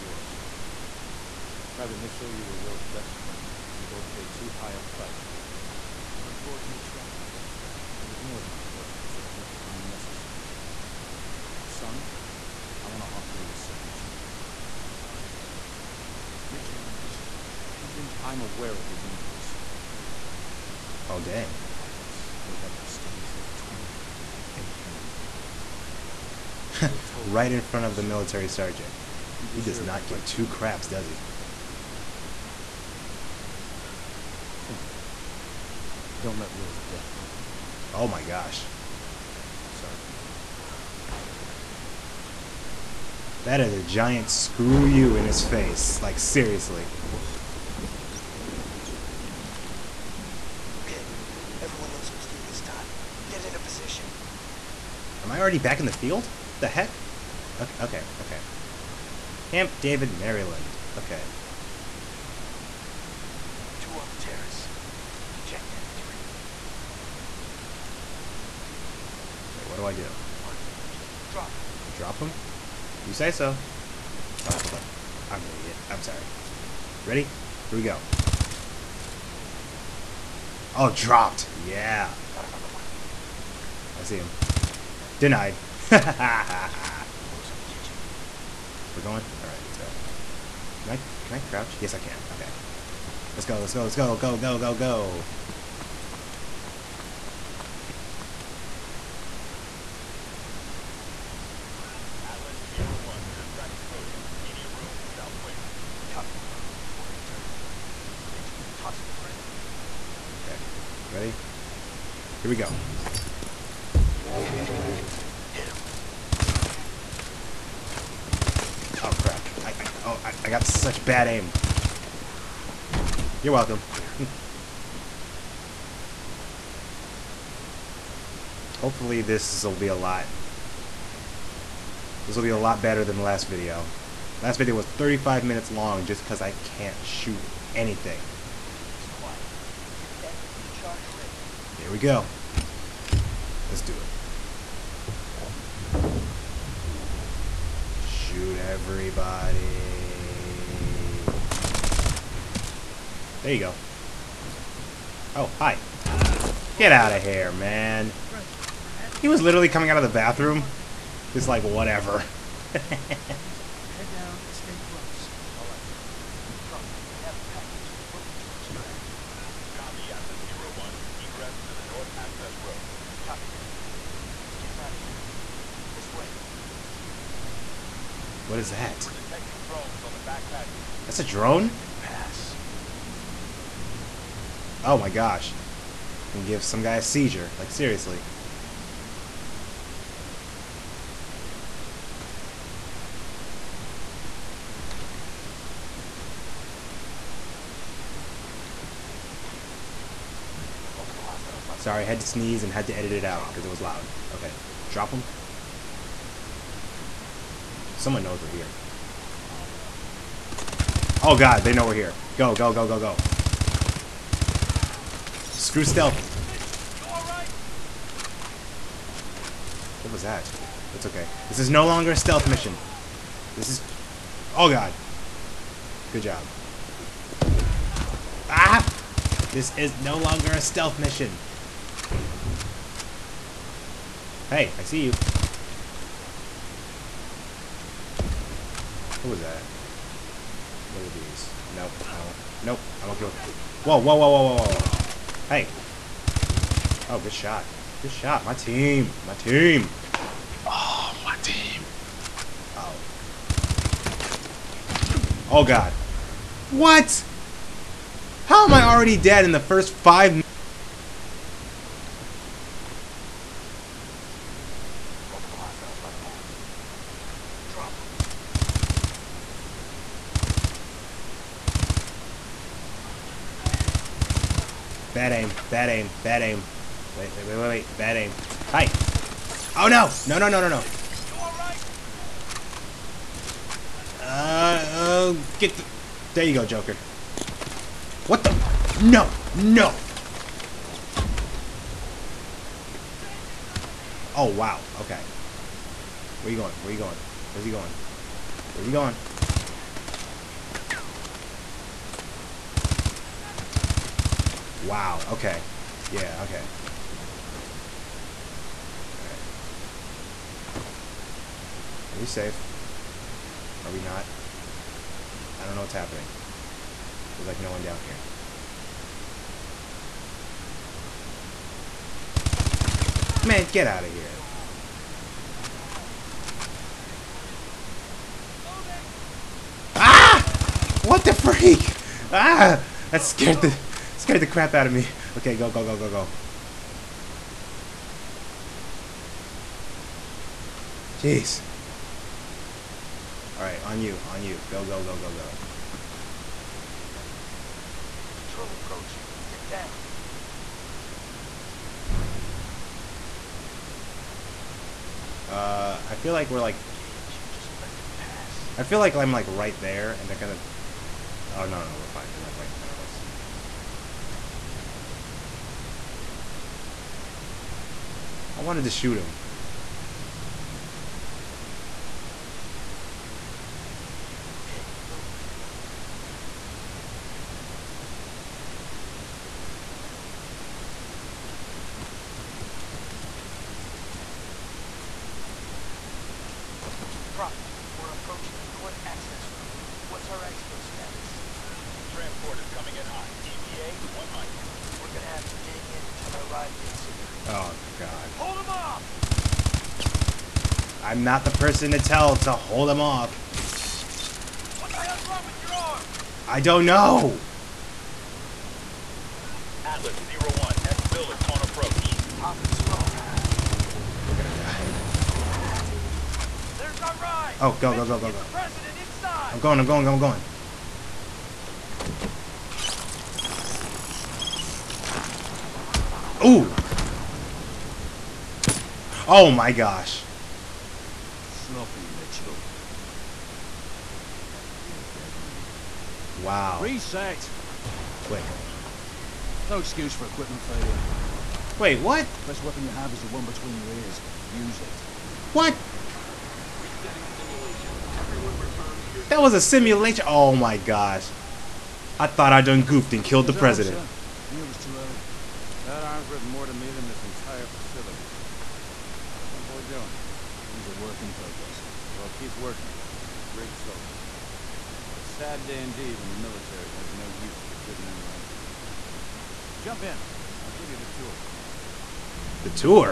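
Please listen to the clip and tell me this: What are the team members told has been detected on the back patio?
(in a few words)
Drones.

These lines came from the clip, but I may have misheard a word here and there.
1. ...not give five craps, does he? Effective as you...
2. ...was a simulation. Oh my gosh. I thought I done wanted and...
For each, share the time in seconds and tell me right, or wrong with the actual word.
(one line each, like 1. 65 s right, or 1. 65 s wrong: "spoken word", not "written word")
1. 29 s wrong: "two", not "five"
2. 449 s wrong: "goofed", not "wanted".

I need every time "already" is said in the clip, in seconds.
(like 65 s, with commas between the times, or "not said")
55 s, 258 s.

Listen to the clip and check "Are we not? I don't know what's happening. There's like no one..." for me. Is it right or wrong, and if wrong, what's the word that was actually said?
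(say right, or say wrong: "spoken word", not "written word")
right.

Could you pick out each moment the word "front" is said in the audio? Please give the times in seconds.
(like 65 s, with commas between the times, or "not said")
27 s, 362 s.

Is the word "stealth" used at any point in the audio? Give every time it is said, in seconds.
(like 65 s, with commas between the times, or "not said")
215 s, 222 s, 230 s.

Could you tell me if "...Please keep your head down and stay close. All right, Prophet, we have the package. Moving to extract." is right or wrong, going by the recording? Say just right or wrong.
right.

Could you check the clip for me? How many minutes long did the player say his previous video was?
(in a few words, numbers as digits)
35.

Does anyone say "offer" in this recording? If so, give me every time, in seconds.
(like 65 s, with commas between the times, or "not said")
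13 s, 25 s.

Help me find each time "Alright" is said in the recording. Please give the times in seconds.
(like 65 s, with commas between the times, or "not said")
89 s, 343 s.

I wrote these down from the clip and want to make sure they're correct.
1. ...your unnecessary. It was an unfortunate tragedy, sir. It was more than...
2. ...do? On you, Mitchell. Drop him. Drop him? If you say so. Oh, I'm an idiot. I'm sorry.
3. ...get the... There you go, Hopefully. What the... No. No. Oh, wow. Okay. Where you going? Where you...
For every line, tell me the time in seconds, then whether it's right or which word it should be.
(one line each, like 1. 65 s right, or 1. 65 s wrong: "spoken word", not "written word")
1. 5 s wrong: "country", not "unnecessary"
2. 69 s right
3. 285 s wrong: "Joker", not "Hopefully".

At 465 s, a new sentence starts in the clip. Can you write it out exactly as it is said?
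It's a sad day indeed when the military has no use for good men like you.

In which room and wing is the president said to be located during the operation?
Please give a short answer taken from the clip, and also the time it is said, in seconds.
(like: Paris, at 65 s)
Media room, south wing, at 104 s.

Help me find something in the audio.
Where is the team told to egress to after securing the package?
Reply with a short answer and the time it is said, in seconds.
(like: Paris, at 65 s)
North Access Road, at 171 s.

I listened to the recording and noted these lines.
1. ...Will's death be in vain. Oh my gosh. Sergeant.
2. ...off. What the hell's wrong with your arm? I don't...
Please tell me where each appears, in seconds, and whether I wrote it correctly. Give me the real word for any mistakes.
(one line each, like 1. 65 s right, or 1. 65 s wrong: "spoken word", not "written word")
1. 36 s right
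2. 402 s right.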